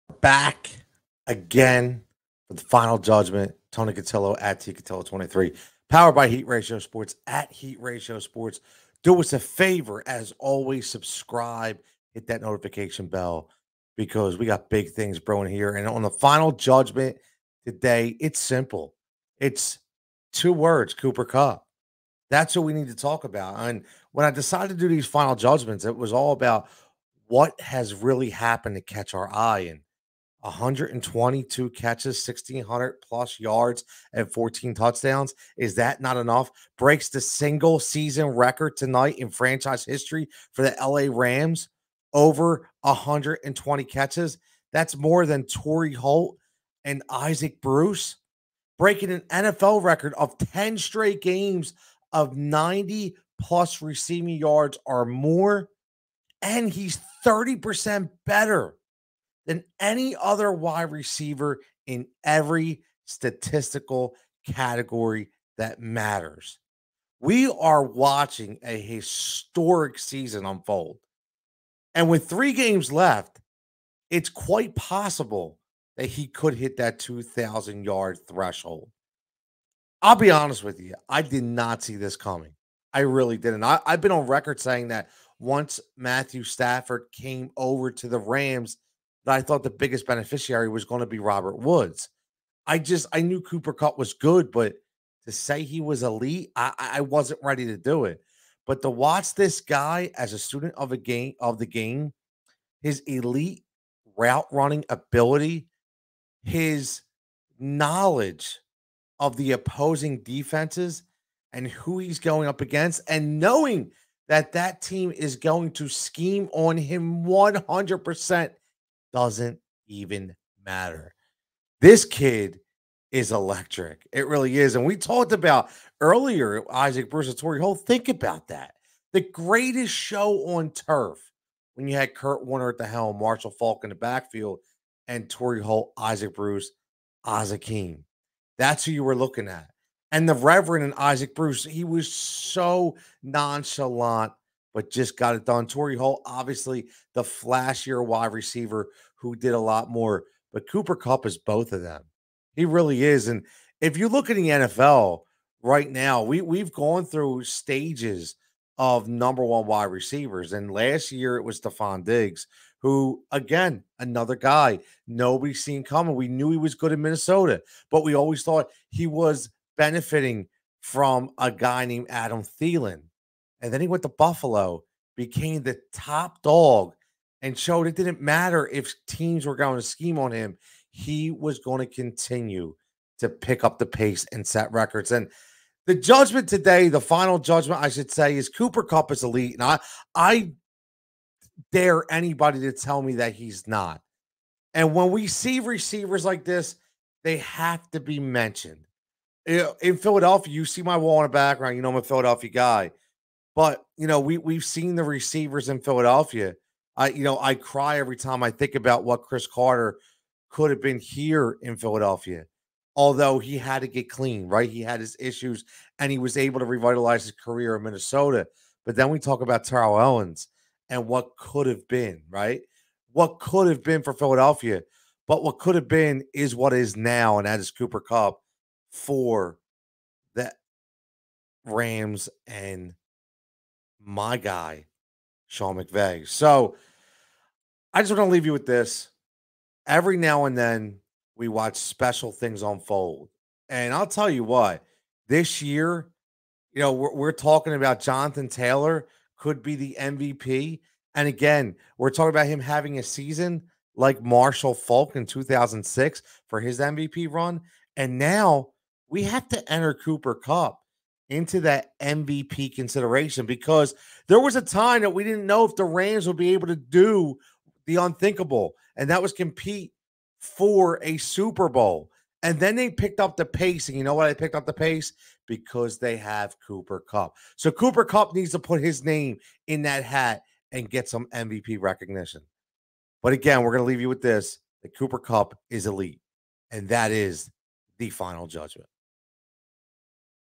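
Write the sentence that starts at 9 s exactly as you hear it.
Do us a favor, as always, subscribe, hit that notification bell because we got big things brewing here.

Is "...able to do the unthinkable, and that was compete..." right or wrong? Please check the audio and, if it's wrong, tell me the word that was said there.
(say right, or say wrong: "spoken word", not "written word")
right.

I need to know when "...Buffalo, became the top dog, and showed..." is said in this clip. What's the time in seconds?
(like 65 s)
174 s.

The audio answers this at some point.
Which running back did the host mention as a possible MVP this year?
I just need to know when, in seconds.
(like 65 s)
247 s.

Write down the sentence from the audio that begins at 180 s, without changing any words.
He was going to continue to pick up the pace and set records.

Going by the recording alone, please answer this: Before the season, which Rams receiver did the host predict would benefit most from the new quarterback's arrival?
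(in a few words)
Robert Woods.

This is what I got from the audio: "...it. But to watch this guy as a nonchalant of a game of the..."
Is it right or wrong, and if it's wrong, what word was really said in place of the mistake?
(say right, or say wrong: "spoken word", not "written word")
wrong: "student", not "nonchalant".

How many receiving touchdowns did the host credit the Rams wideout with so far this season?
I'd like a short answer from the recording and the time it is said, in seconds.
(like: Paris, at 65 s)
14, at 34 s.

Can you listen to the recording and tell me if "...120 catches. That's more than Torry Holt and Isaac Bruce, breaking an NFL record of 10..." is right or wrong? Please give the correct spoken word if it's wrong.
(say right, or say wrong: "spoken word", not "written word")
right.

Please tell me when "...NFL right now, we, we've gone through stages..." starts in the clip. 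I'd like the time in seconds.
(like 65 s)
154 s.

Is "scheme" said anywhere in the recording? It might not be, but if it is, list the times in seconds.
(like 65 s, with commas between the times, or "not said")
115 s, 179 s.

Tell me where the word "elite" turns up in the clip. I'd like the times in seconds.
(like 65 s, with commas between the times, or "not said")
96 s, 103 s, 189 s, 285 s.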